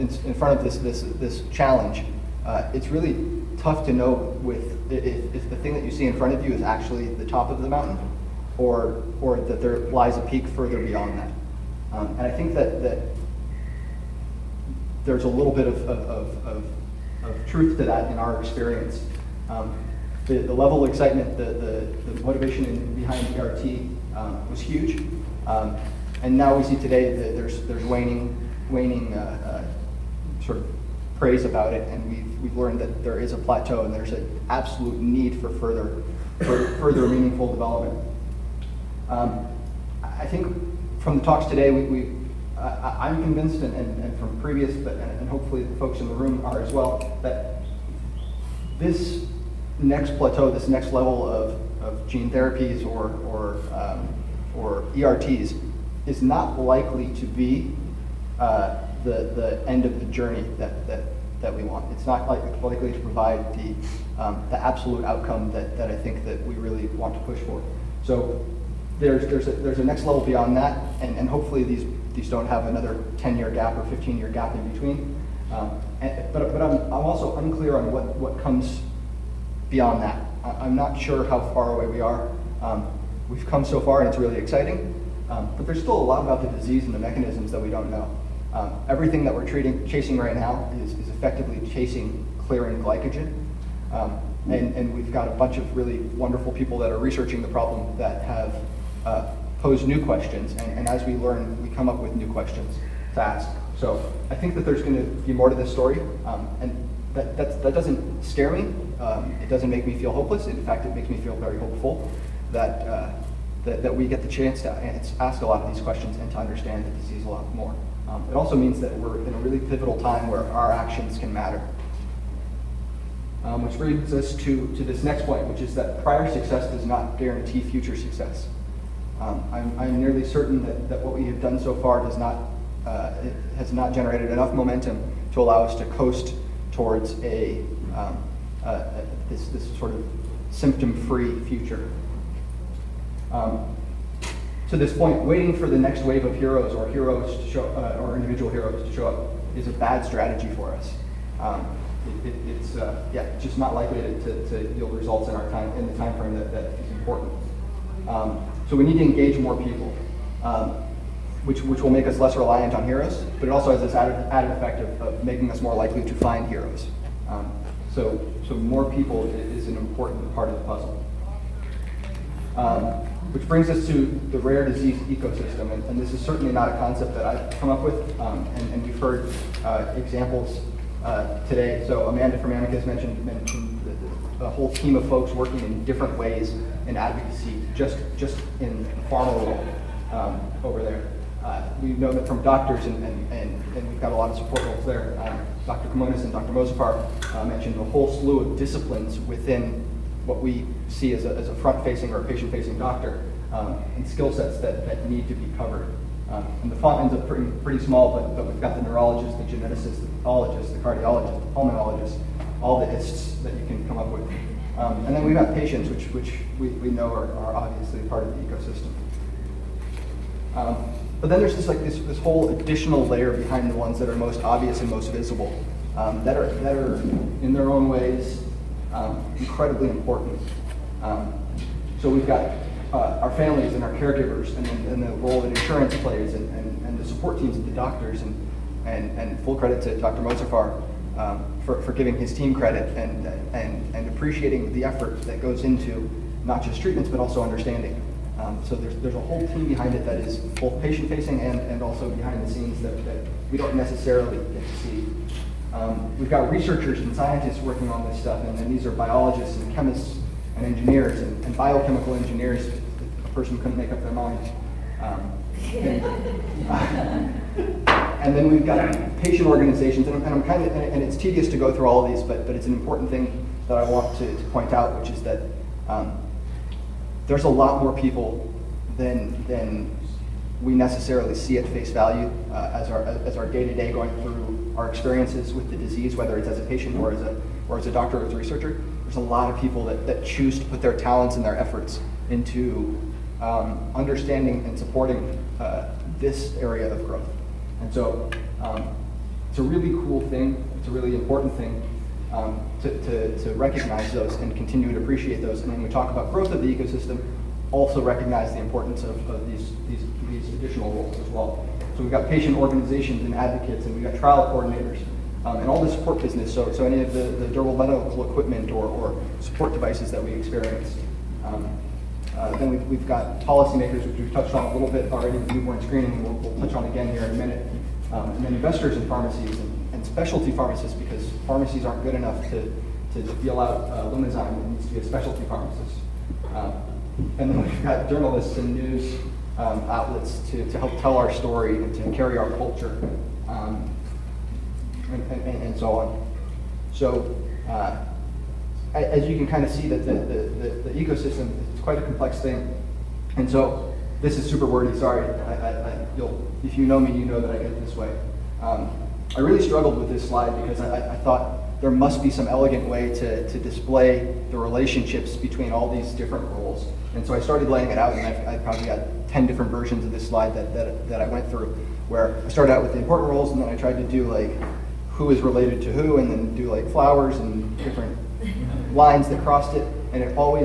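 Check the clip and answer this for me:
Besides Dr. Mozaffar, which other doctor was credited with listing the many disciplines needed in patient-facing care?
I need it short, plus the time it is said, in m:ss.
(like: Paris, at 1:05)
Dr. Kimonis, at 3:15.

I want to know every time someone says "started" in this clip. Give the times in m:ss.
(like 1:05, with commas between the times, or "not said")
6:07, 6:12.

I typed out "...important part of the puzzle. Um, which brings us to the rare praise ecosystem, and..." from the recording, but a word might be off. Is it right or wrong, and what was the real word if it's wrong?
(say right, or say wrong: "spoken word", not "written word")
wrong: "disease", not "praise".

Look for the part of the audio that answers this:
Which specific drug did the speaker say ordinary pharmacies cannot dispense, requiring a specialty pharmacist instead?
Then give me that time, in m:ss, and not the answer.
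5:34.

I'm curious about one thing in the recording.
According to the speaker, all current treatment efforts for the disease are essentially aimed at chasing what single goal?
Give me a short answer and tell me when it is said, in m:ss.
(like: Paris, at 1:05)
Clearing glycogen, at 1:32.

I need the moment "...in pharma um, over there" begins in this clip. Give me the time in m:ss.
3:08.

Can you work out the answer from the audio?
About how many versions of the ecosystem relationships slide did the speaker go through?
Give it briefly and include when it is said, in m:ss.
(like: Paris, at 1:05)
10, at 6:09.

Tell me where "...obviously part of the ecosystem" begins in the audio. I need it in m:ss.
3:37.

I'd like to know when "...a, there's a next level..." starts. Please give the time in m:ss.
1:09.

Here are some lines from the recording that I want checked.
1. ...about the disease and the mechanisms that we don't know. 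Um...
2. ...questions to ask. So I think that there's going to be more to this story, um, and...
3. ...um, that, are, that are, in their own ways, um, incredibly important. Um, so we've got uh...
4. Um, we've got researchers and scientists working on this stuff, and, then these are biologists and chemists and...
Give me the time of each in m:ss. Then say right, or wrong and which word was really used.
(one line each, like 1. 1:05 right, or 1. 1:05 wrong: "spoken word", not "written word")
1. 1:26 right
2. 1:42 right
3. 3:45 right
4. 4:15 right.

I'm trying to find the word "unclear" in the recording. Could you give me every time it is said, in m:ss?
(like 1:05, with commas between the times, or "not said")
1:17.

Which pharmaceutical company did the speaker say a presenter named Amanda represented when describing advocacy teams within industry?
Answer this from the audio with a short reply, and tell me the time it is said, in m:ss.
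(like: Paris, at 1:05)
Amicus, at 3:02.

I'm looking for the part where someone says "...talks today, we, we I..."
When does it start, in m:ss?
0:41.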